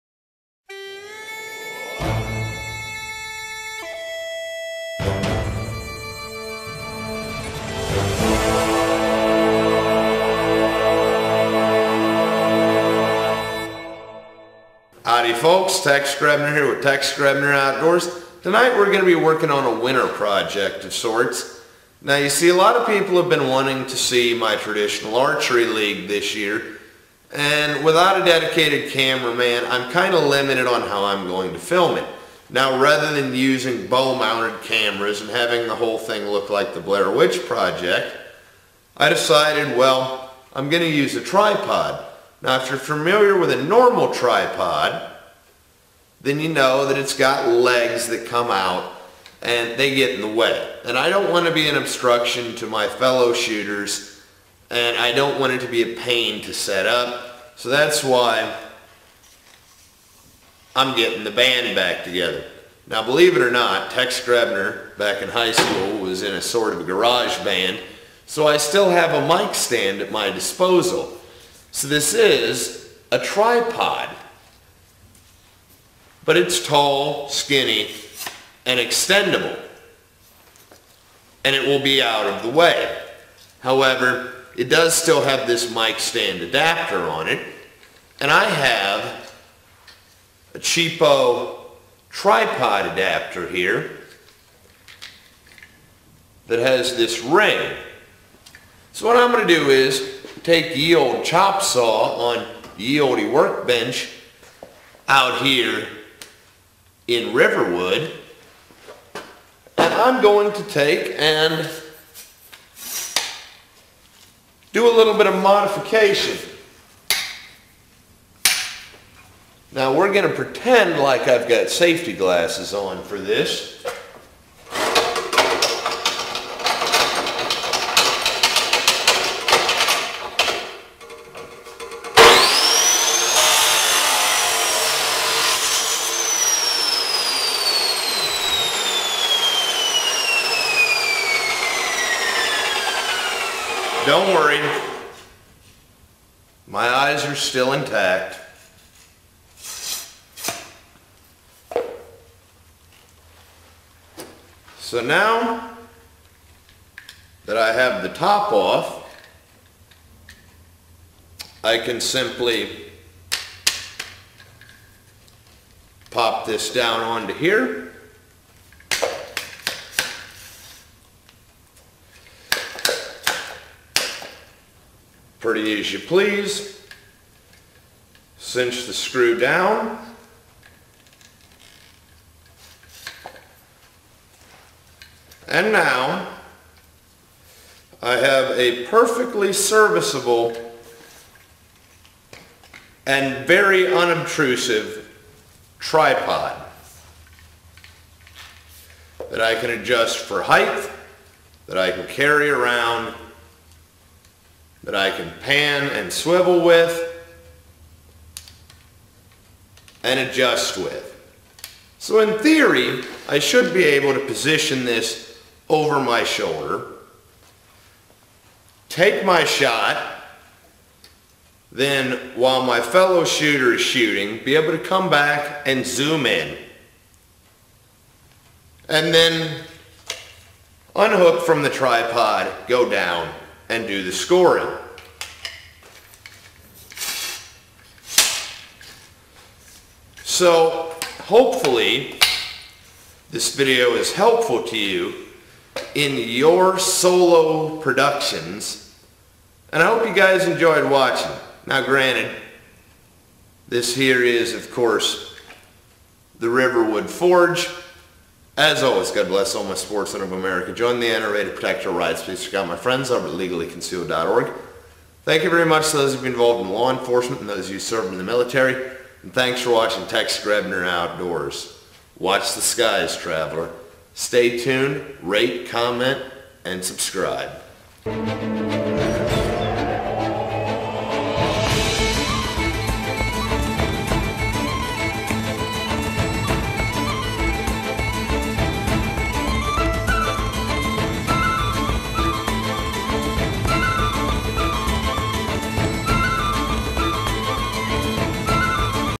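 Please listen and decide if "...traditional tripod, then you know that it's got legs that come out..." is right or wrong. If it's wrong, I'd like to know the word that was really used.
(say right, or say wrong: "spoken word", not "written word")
wrong: "normal", not "traditional".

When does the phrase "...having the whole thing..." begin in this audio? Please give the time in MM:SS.
00:35.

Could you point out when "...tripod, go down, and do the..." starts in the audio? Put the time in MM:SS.
03:51.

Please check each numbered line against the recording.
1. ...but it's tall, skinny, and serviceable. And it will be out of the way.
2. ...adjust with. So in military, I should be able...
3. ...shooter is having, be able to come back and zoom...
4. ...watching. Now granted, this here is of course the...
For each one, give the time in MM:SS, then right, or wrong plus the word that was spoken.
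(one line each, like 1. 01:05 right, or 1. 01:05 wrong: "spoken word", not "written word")
1. 01:16 wrong: "extendable", not "serviceable"
2. 03:30 wrong: "theory", not "military"
3. 03:43 wrong: "shooting", not "having"
4. 04:10 right.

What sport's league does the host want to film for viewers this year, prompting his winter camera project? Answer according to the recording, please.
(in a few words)
Traditional archery.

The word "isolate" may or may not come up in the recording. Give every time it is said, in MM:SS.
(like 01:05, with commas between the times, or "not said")
not said.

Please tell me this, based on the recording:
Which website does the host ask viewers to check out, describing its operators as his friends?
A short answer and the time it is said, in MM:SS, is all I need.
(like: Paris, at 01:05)
legallyconcealed.org, at 04:23.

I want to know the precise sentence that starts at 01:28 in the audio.
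And I have a cheapo tripod adapter here that has this ring.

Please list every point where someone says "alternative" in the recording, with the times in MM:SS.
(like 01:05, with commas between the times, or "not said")
not said.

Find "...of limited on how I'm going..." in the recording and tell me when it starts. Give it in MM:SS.
00:30.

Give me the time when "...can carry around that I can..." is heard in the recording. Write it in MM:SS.
03:21.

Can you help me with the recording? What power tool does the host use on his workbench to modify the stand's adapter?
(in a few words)
Chop saw.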